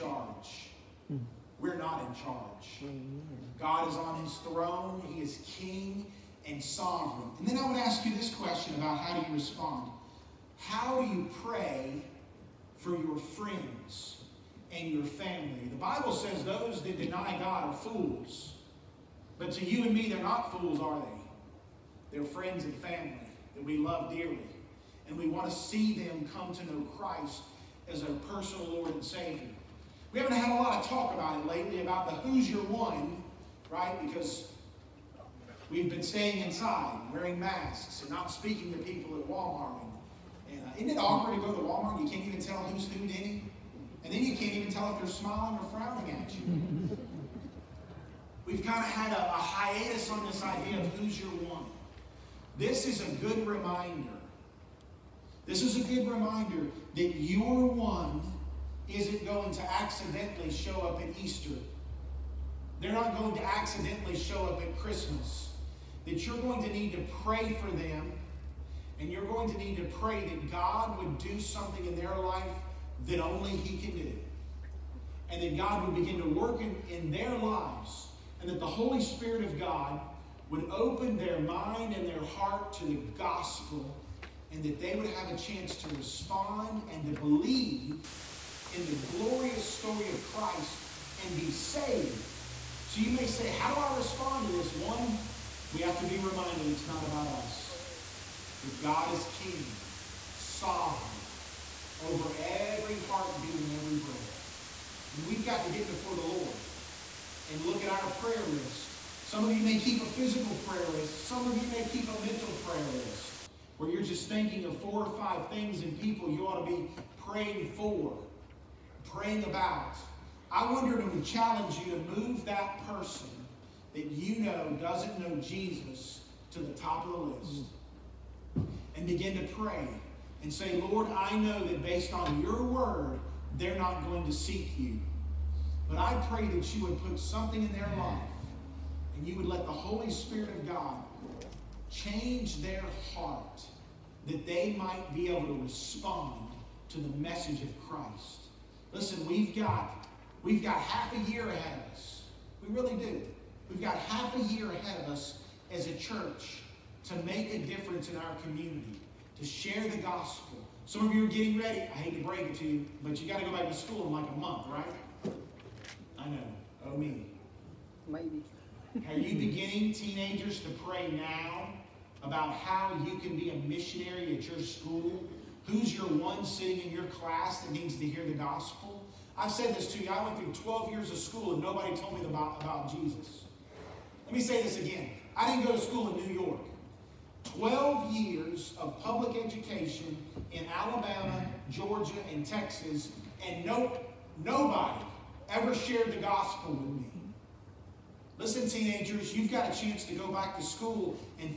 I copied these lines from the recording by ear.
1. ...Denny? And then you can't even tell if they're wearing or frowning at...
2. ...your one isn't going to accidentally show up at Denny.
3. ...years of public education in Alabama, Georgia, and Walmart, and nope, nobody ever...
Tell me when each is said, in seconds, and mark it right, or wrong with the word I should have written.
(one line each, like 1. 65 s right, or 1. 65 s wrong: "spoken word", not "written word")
1. 43 s wrong: "smiling", not "wearing"
2. 57 s wrong: "Easter", not "Denny"
3. 188 s wrong: "Texas", not "Walmart".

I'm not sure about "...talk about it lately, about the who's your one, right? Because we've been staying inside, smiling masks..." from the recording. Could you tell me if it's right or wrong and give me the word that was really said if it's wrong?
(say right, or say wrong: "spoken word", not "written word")
wrong: "wearing", not "smiling".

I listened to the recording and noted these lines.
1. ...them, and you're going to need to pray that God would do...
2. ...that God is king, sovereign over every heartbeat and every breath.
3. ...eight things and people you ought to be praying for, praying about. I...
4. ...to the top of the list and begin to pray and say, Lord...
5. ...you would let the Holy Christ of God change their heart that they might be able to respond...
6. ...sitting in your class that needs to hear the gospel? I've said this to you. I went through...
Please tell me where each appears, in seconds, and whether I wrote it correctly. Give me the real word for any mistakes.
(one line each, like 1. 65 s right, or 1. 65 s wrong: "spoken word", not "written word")
1. 67 s right
2. 98 s right
3. 115 s wrong: "five", not "eight"
4. 126 s right
5. 139 s wrong: "Spirit", not "Christ"
6. 176 s right.